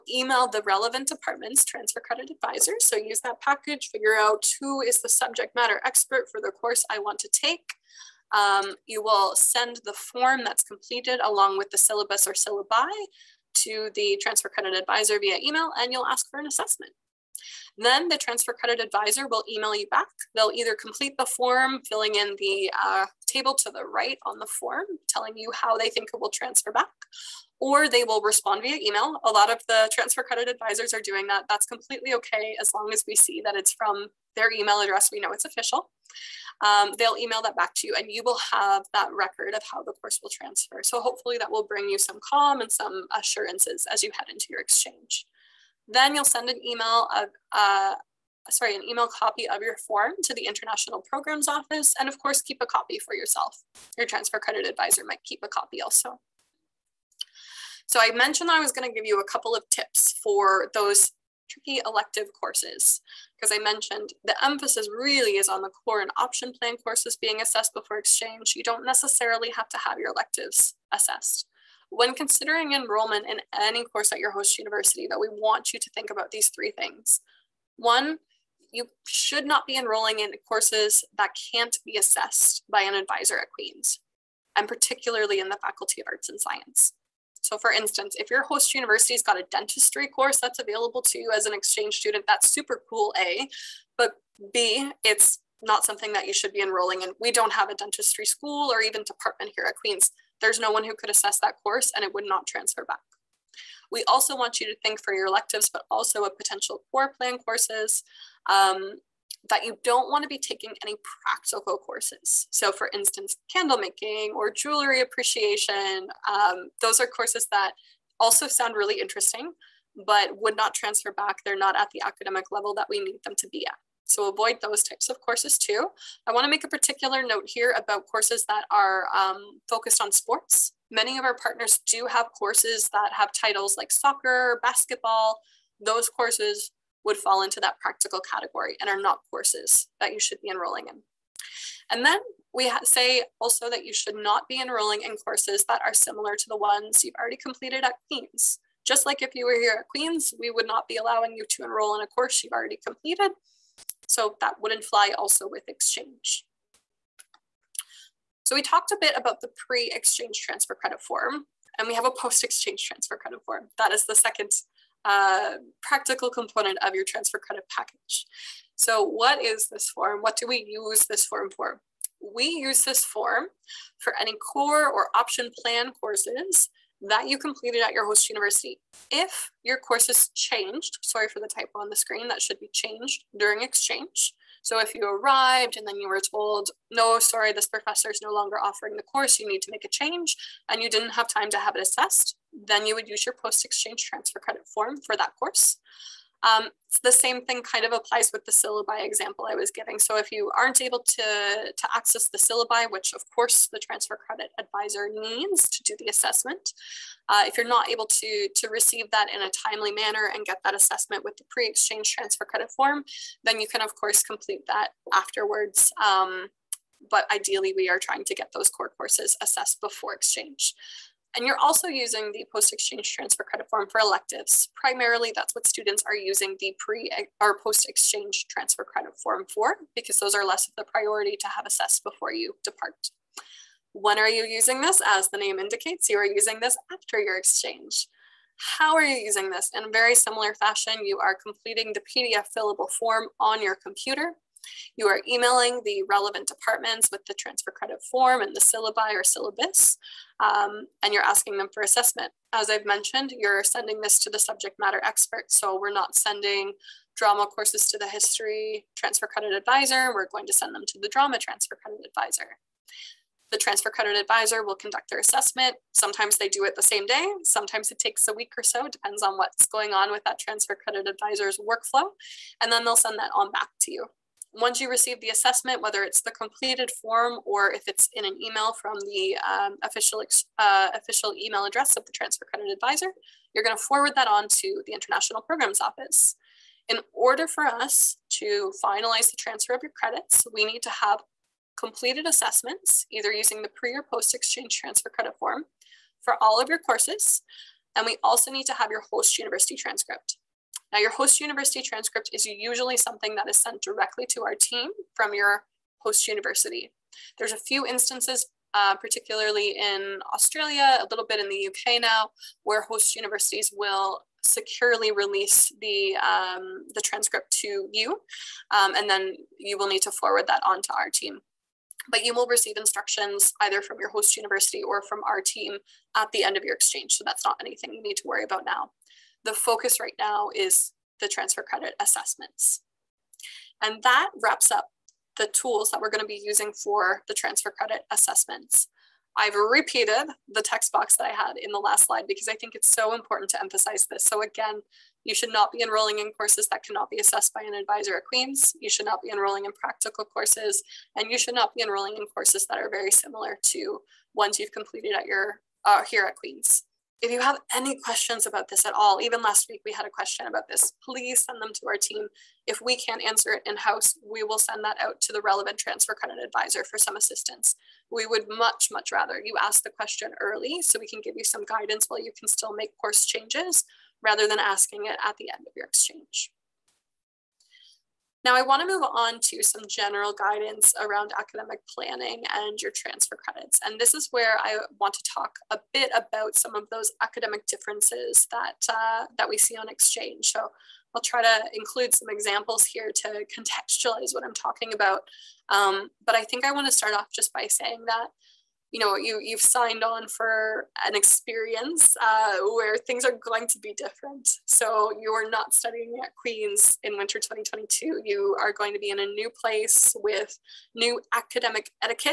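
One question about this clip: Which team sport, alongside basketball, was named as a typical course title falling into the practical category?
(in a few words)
Soccer.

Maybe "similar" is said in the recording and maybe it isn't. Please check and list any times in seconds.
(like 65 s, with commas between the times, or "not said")
145 s, 240 s, 353 s.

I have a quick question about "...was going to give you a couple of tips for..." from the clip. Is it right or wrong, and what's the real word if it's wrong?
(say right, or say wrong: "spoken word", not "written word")
right.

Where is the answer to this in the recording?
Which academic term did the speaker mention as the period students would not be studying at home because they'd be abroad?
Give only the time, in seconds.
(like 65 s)
407 s.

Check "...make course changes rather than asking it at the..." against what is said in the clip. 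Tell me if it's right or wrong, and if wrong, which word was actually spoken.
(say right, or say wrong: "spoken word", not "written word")
right.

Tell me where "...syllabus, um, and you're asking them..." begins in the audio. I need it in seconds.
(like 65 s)
249 s.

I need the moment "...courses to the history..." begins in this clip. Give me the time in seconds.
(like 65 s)
257 s.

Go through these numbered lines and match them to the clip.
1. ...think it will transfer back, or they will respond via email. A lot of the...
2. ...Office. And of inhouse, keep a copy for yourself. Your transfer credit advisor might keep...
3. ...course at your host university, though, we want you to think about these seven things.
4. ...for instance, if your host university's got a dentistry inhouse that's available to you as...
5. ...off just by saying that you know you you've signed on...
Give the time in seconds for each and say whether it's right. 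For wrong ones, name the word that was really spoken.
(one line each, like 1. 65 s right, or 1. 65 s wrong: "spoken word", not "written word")
1. 25 s right
2. 51 s wrong: "course", not "inhouse"
3. 73 s wrong: "three", not "seven"
4. 87 s wrong: "course", not "inhouse"
5. 397 s right.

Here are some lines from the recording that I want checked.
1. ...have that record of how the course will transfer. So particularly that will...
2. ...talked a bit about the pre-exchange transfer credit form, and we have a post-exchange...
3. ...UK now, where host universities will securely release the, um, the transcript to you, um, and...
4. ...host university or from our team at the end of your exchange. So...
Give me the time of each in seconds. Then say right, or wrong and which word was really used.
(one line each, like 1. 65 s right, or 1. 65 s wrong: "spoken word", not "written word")
1. 38 s wrong: "hopefully", not "particularly"
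2. 158 s right
3. 311 s right
4. 324 s right.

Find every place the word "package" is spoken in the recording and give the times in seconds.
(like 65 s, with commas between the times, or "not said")
3 s, 167 s.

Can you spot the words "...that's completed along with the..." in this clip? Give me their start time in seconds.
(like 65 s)
10 s.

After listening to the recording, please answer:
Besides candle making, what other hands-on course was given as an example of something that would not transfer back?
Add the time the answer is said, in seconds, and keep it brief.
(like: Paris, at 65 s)
Jewelry appreciation, at 114 s.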